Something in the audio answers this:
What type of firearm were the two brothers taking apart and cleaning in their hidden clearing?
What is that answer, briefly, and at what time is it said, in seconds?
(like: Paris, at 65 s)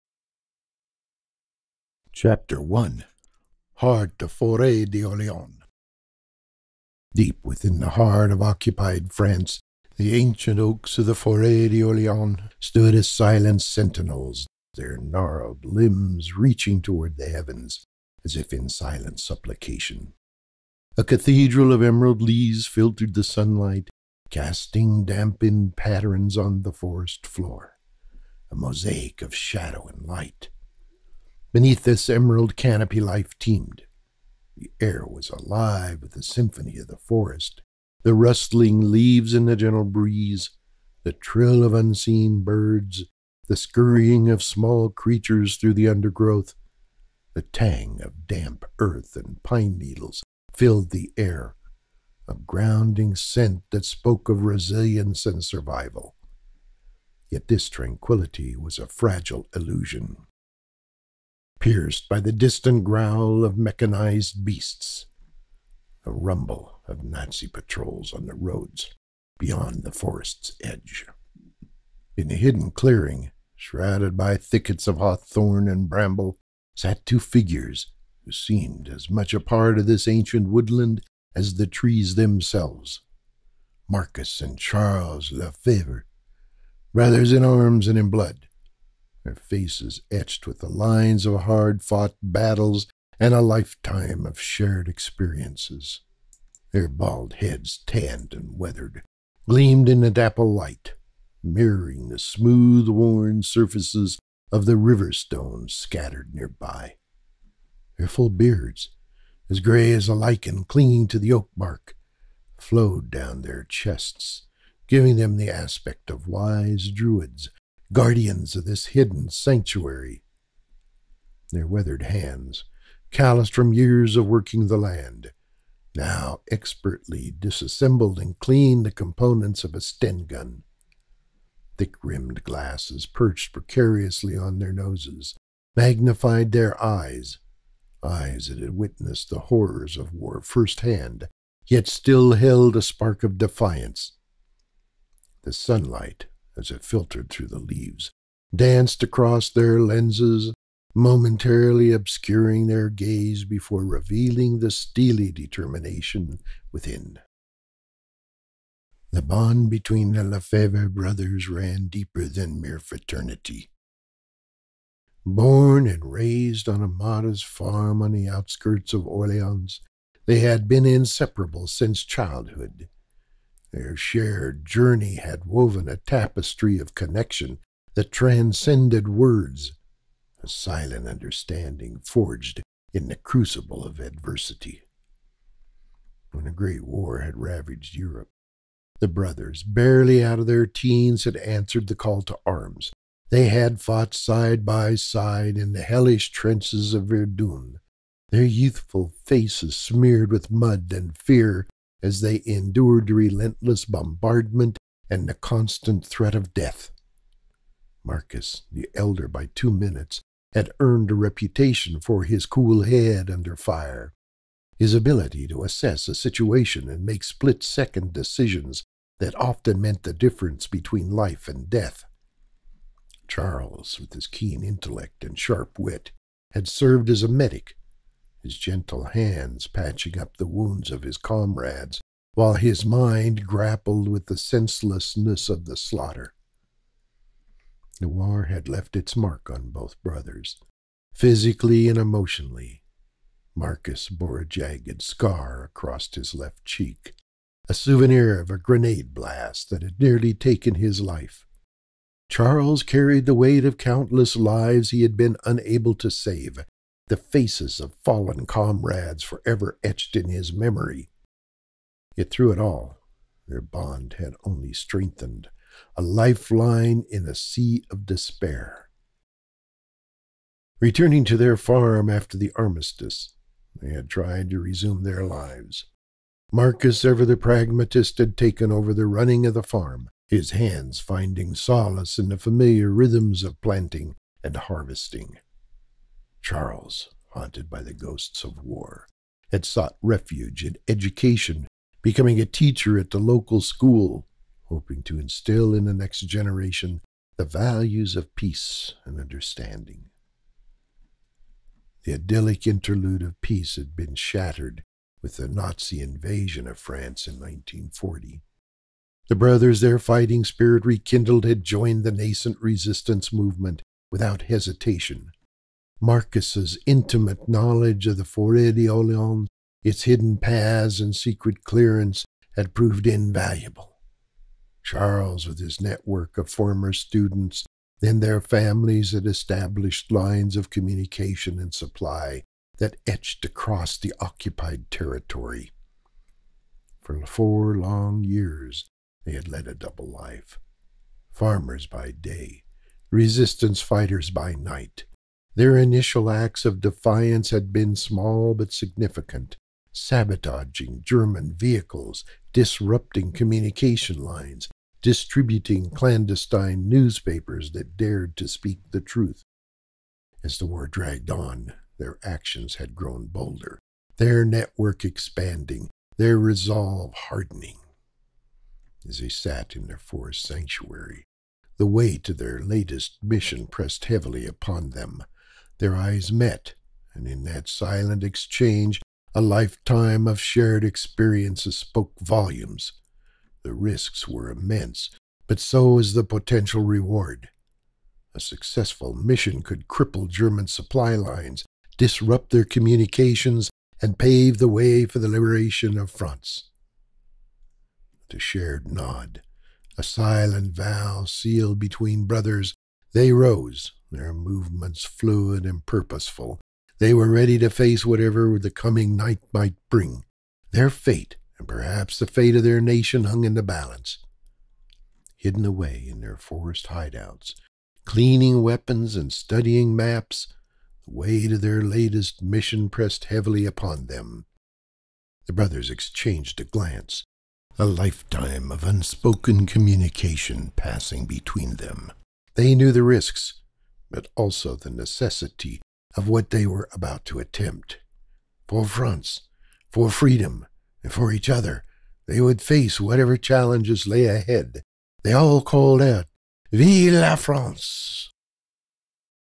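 Sten gun, at 129 s.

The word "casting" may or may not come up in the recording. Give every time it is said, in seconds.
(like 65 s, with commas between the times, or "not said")
24 s.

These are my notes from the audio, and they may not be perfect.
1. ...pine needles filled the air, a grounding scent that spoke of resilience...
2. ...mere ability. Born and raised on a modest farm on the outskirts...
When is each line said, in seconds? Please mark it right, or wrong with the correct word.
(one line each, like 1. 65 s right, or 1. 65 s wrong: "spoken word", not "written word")
1. 49 s right
2. 162 s wrong: "fraternity", not "ability".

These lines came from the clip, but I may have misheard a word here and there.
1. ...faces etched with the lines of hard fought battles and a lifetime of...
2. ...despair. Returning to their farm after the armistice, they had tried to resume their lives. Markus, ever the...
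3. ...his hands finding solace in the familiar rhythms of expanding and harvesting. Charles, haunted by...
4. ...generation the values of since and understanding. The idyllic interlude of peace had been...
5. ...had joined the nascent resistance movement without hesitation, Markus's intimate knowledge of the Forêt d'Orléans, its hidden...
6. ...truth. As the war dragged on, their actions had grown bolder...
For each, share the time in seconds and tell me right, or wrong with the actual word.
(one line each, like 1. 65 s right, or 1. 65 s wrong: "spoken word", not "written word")
1. 89 s right
2. 268 s right
3. 280 s wrong: "planting", not "expanding"
4. 296 s wrong: "peace", not "since"
5. 311 s right
6. 359 s right.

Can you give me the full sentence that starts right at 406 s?
They were ready to face whatever the coming night might bring.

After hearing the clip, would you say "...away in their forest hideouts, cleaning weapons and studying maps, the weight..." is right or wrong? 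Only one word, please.
right.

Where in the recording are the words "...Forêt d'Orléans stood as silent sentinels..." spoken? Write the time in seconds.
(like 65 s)
11 s.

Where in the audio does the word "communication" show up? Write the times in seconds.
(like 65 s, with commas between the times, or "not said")
330 s, 353 s, 392 s, 429 s.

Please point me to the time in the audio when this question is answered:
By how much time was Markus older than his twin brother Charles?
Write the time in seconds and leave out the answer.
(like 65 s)
209 s.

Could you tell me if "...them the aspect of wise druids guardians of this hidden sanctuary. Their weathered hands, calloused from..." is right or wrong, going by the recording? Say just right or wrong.
right.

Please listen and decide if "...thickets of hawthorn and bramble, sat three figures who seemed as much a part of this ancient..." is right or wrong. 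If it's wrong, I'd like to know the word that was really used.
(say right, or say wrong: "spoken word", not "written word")
wrong: "two", not "three".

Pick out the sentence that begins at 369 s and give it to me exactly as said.
As they sat in their forest sanctuary, the weight of their latest mission pressed heavily upon them.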